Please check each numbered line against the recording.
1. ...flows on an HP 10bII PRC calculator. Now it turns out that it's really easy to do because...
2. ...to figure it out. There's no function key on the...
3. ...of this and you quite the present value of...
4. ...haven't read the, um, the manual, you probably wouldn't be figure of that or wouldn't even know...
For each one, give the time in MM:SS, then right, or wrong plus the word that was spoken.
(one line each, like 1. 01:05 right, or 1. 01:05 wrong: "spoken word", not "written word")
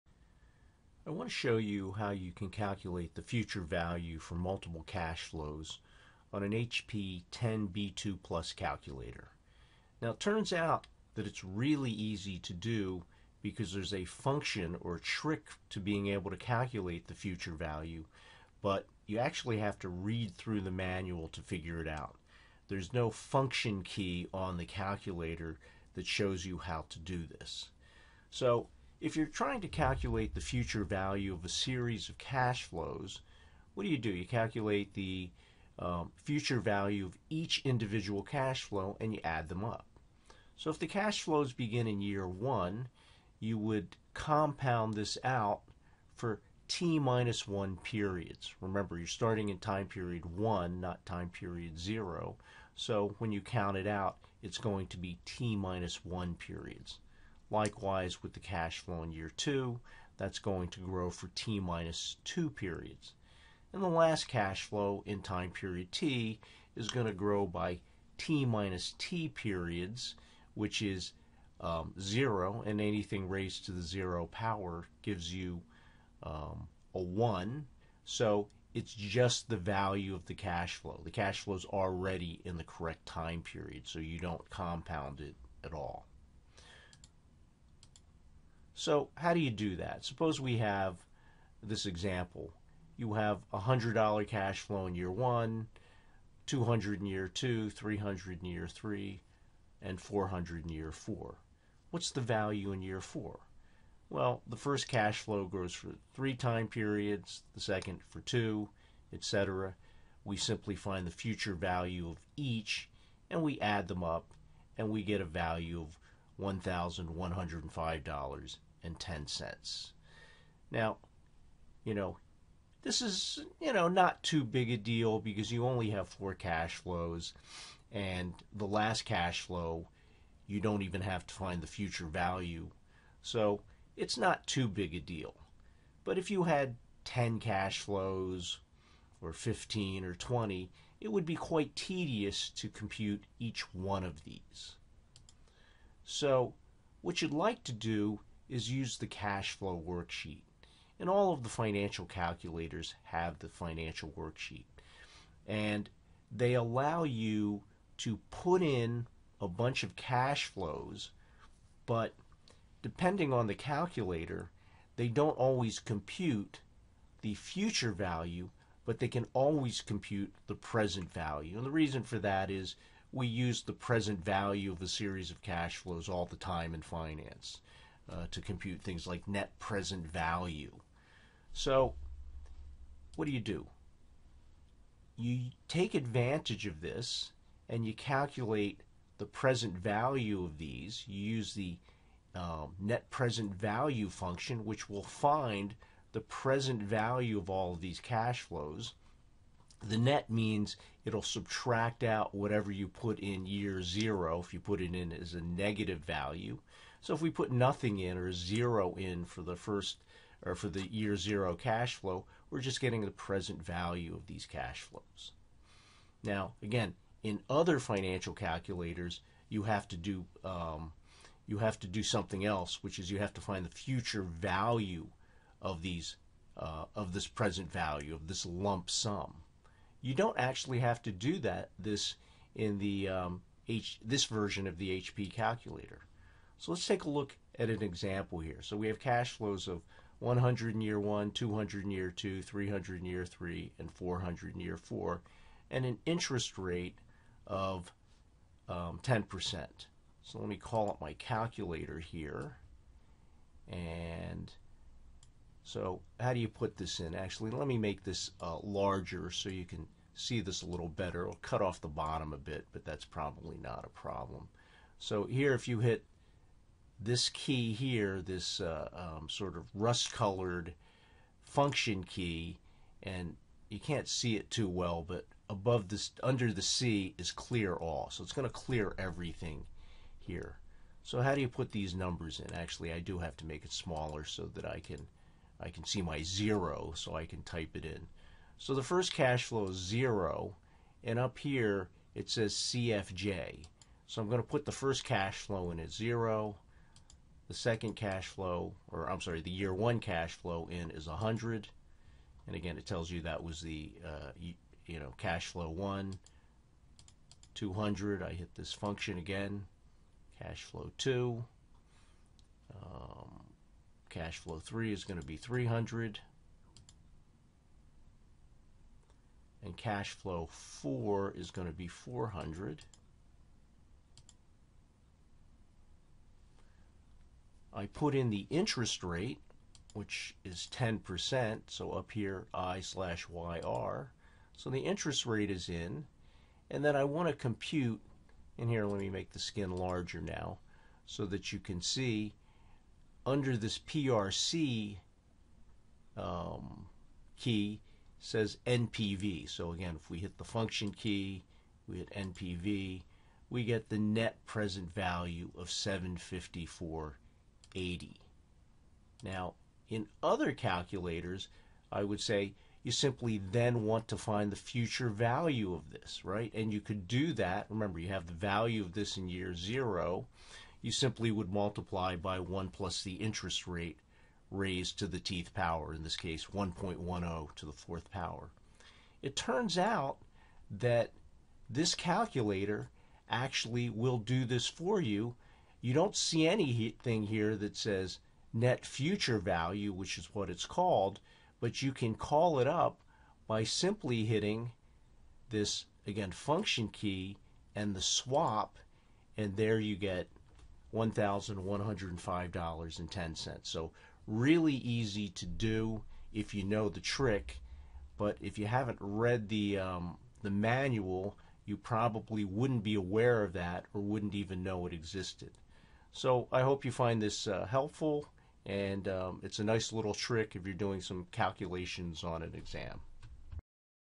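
1. 00:05 wrong: "Plus", not "PRC"
2. 00:21 right
3. 03:06 wrong: "calculate", not "quite"
4. 06:48 wrong: "aware", not "figure".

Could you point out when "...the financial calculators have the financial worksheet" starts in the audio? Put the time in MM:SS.
02:31.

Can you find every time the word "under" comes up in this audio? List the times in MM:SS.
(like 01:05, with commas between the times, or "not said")
04:36, 05:43.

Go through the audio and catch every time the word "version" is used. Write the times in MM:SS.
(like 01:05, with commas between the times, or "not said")
03:54.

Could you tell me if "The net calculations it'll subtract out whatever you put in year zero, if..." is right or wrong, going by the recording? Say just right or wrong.
wrong.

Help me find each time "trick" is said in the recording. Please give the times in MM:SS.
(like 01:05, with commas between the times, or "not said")
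00:14, 06:46, 07:00.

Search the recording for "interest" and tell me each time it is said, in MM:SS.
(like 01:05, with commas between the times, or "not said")
04:06, 05:28, 05:34, 06:13.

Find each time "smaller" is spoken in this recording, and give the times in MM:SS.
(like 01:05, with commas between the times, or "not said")
04:43.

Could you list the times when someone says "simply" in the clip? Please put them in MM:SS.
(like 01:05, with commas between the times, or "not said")
01:50, 06:02, 06:10, 06:33.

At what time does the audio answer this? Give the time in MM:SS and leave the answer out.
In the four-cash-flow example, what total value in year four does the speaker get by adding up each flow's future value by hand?
01:56.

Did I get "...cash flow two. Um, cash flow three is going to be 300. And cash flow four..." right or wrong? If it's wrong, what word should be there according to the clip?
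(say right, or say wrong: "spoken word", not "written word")
right.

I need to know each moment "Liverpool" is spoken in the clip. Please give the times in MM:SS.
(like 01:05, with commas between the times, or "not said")
not said.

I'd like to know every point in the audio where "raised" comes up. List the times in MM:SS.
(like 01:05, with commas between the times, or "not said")
01:13, 06:14.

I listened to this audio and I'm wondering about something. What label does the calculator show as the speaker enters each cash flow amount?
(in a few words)
CFJ.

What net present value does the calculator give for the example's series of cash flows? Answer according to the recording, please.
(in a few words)
754.80.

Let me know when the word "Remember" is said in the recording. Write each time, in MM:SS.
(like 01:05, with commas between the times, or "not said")
00:48, 06:07.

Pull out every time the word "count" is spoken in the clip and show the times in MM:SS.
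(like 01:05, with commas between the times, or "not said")
00:53.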